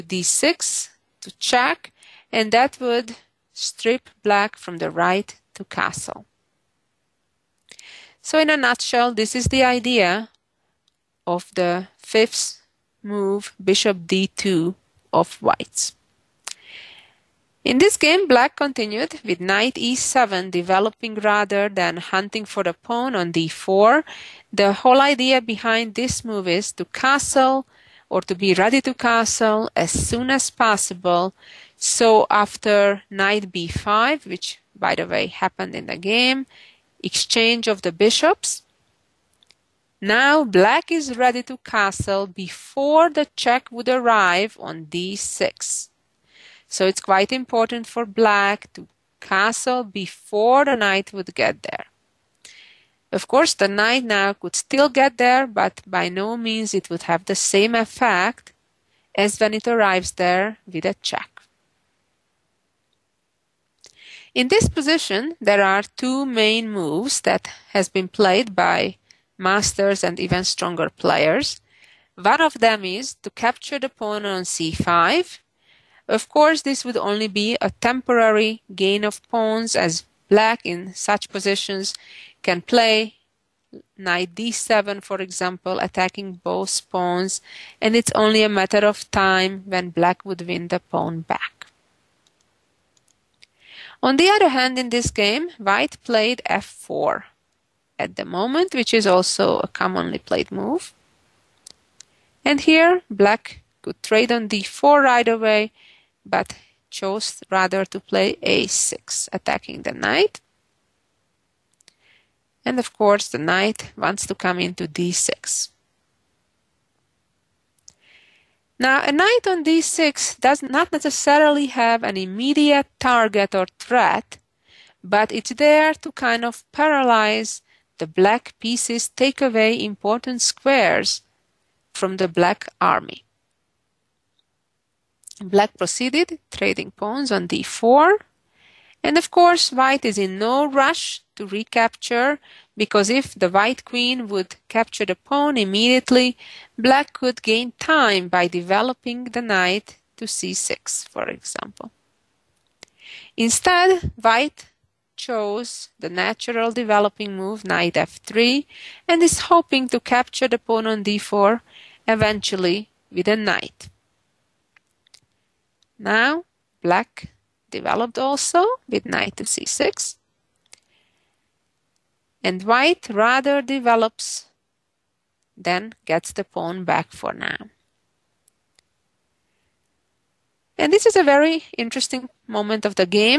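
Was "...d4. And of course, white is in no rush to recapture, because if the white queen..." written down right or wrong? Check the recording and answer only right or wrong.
right.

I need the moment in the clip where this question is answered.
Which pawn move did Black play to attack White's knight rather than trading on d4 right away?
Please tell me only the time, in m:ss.
1:48.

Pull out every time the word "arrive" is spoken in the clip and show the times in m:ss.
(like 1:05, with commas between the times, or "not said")
0:43, 0:59.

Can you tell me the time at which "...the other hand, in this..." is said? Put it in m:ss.
1:34.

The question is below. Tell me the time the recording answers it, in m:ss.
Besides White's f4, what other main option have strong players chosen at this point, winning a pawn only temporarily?
1:13.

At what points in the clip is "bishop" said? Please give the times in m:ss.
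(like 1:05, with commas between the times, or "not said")
0:13, 0:37.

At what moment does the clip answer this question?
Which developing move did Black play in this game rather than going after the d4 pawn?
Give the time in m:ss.
0:19.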